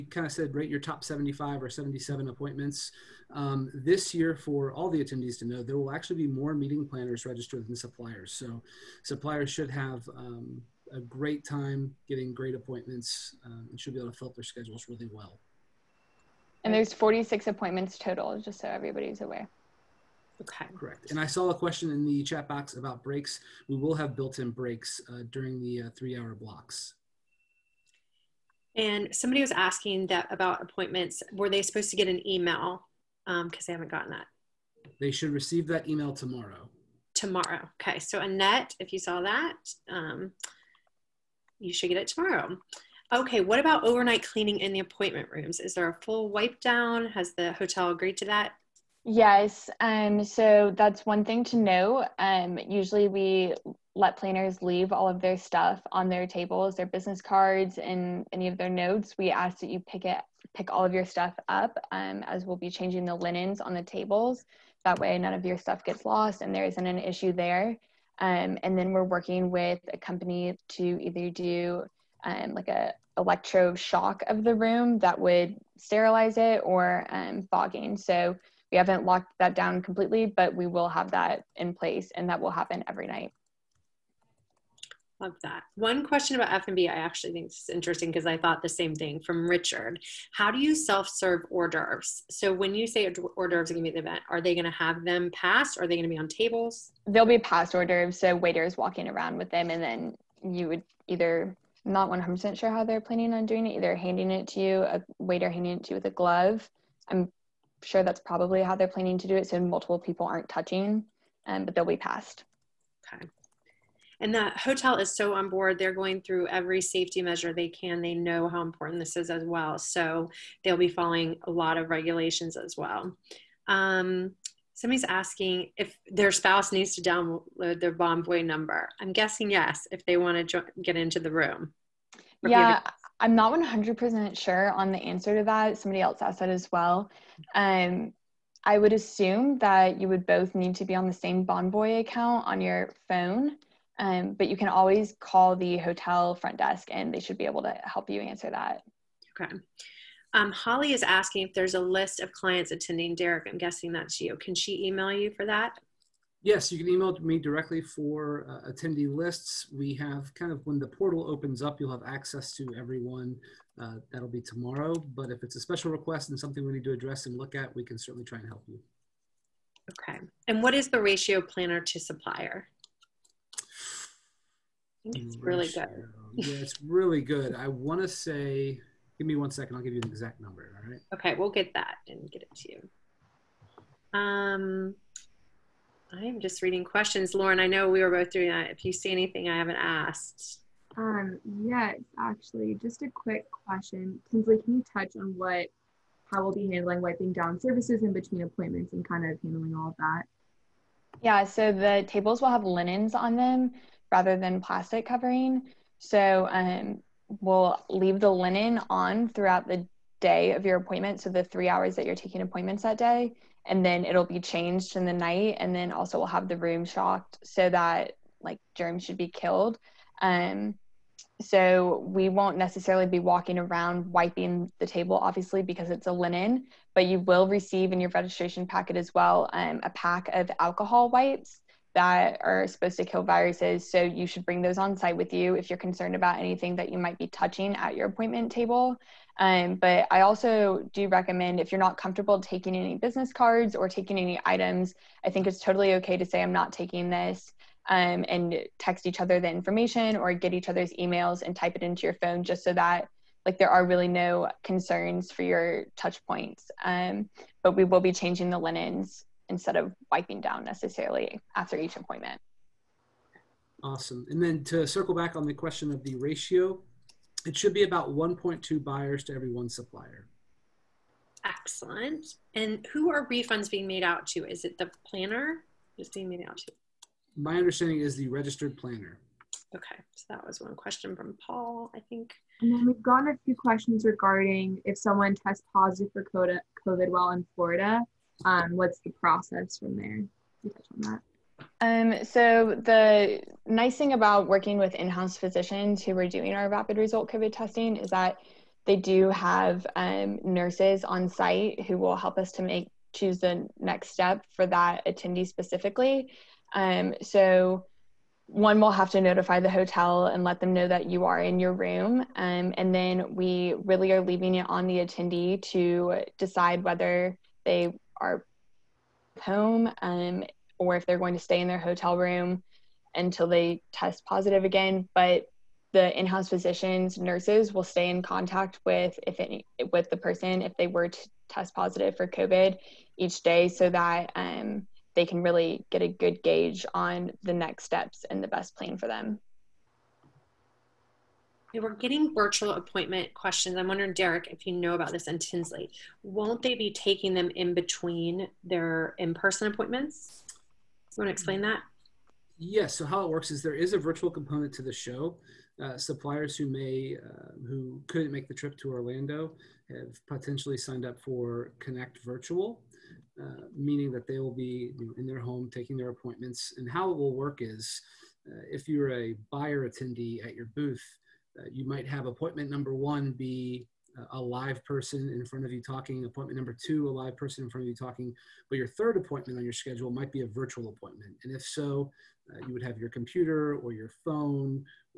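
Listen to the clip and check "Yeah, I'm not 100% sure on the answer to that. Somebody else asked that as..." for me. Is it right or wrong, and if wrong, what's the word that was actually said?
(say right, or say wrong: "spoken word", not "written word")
right.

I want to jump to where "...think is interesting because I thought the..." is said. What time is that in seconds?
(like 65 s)
87 s.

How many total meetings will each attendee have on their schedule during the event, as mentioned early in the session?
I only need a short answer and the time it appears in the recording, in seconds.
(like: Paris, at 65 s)
46, at 16 s.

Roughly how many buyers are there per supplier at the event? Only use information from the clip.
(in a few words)
1.2.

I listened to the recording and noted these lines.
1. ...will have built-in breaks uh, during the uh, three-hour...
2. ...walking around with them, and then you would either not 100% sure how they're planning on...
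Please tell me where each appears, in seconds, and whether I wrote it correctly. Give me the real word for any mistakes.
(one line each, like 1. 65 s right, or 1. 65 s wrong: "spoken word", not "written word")
1. 23 s right
2. 98 s right.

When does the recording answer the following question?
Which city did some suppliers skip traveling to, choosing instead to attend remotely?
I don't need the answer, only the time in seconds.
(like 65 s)
358 s.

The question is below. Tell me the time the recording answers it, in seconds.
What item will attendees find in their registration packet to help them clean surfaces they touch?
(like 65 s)
230 s.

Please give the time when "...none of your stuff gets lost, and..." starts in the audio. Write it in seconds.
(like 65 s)
65 s.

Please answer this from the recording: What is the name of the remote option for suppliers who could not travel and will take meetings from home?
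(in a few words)
Connect Virtual.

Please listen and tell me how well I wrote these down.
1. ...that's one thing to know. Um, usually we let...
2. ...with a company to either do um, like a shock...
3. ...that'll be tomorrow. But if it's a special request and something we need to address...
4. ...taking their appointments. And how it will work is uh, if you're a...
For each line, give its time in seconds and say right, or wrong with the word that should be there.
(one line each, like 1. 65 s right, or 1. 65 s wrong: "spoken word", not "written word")
1. 50 s right
2. 69 s right
3. 164 s right
4. 365 s right.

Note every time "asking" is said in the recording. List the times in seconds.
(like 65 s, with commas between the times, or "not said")
29 s, 125 s, 151 s.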